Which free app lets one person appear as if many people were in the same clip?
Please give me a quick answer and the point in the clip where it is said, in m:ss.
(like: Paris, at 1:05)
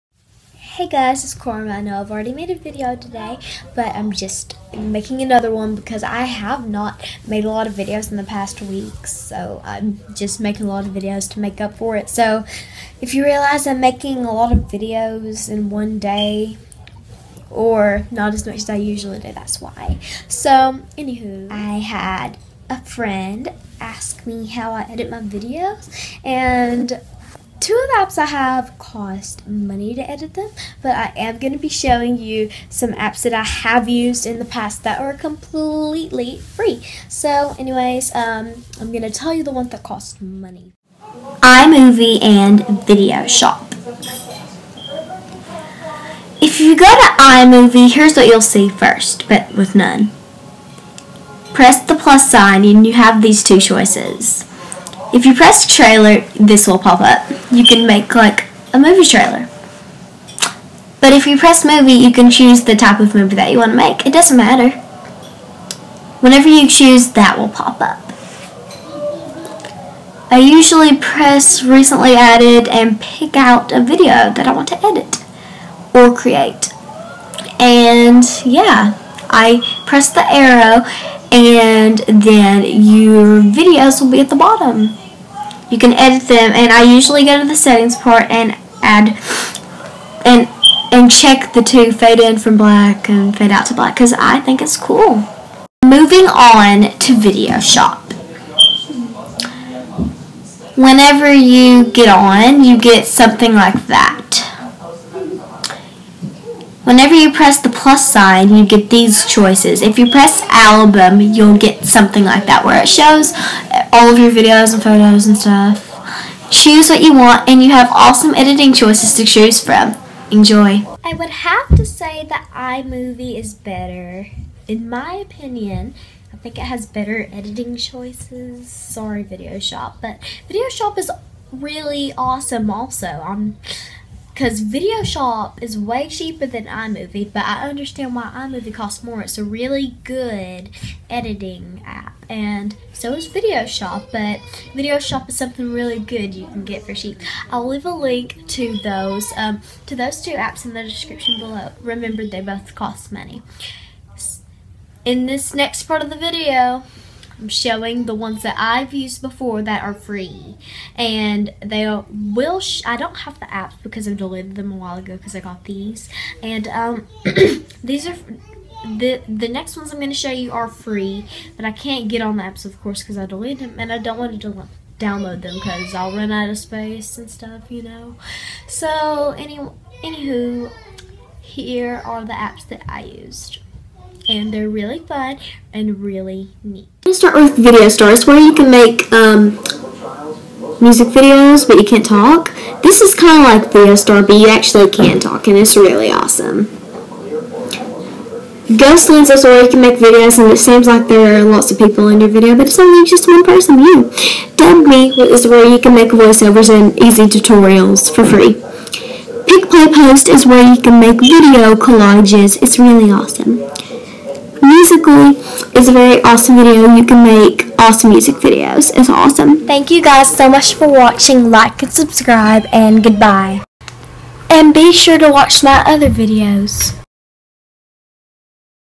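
Ghost Lens, at 3:18.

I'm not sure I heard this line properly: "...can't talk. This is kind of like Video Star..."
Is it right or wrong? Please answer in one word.
right.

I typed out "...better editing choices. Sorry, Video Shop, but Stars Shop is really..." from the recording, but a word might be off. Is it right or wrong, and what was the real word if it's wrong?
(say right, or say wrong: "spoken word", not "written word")
wrong: "Video", not "Stars".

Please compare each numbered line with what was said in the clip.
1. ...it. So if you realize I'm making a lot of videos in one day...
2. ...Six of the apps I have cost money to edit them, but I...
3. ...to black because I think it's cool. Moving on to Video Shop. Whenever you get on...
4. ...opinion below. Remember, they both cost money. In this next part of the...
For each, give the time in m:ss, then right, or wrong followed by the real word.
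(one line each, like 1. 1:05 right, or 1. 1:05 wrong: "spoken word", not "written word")
1. 0:11 right
2. 0:27 wrong: "Two", not "Six"
3. 1:33 right
4. 2:30 wrong: "description", not "opinion".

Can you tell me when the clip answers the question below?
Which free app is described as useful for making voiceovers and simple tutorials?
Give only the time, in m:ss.
3:24.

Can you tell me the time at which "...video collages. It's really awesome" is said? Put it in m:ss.
3:31.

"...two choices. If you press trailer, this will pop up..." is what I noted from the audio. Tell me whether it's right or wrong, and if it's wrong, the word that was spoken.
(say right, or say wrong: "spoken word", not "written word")
right.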